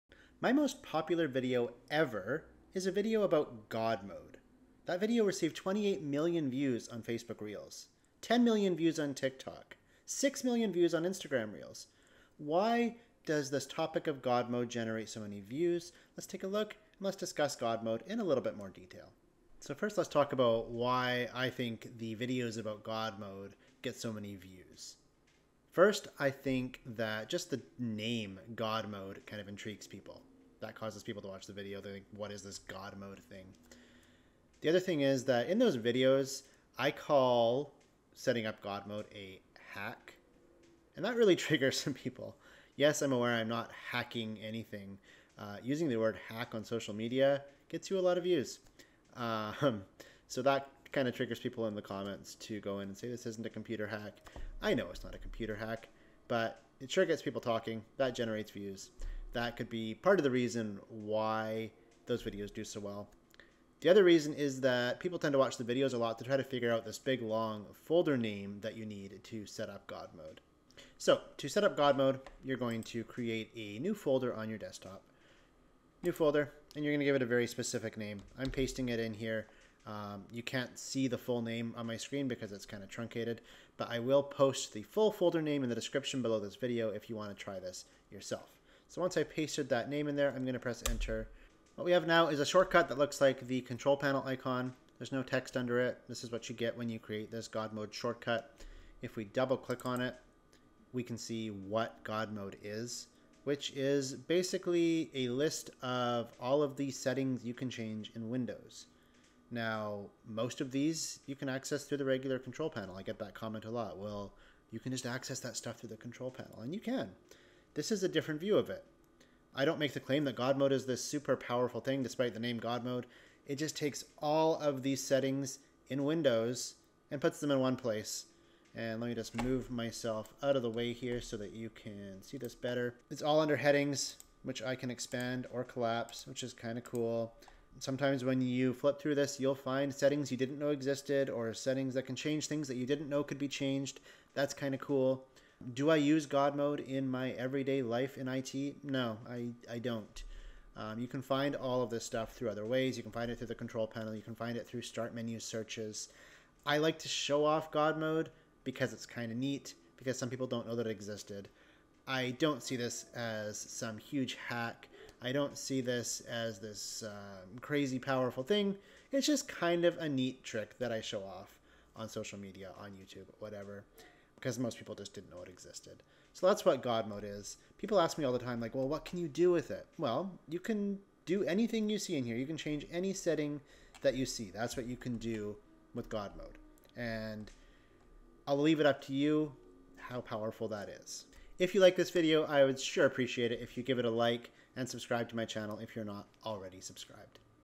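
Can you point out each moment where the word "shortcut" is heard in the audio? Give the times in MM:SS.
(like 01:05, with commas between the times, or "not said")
01:32, 01:37.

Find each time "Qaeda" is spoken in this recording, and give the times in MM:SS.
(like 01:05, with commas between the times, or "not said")
not said.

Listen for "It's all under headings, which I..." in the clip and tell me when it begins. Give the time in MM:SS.
02:13.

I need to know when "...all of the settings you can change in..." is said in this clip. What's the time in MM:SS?
01:46.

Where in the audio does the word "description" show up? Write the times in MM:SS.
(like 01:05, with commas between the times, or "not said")
01:25.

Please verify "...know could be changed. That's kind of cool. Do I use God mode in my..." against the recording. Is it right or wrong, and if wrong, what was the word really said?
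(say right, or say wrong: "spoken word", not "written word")
right.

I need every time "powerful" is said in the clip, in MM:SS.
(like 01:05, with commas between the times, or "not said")
02:01, 02:47, 03:10.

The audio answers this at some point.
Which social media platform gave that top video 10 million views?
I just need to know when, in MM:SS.
00:09.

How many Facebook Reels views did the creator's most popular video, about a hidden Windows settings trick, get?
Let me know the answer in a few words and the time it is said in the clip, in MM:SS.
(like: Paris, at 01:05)
28 million, at 00:05.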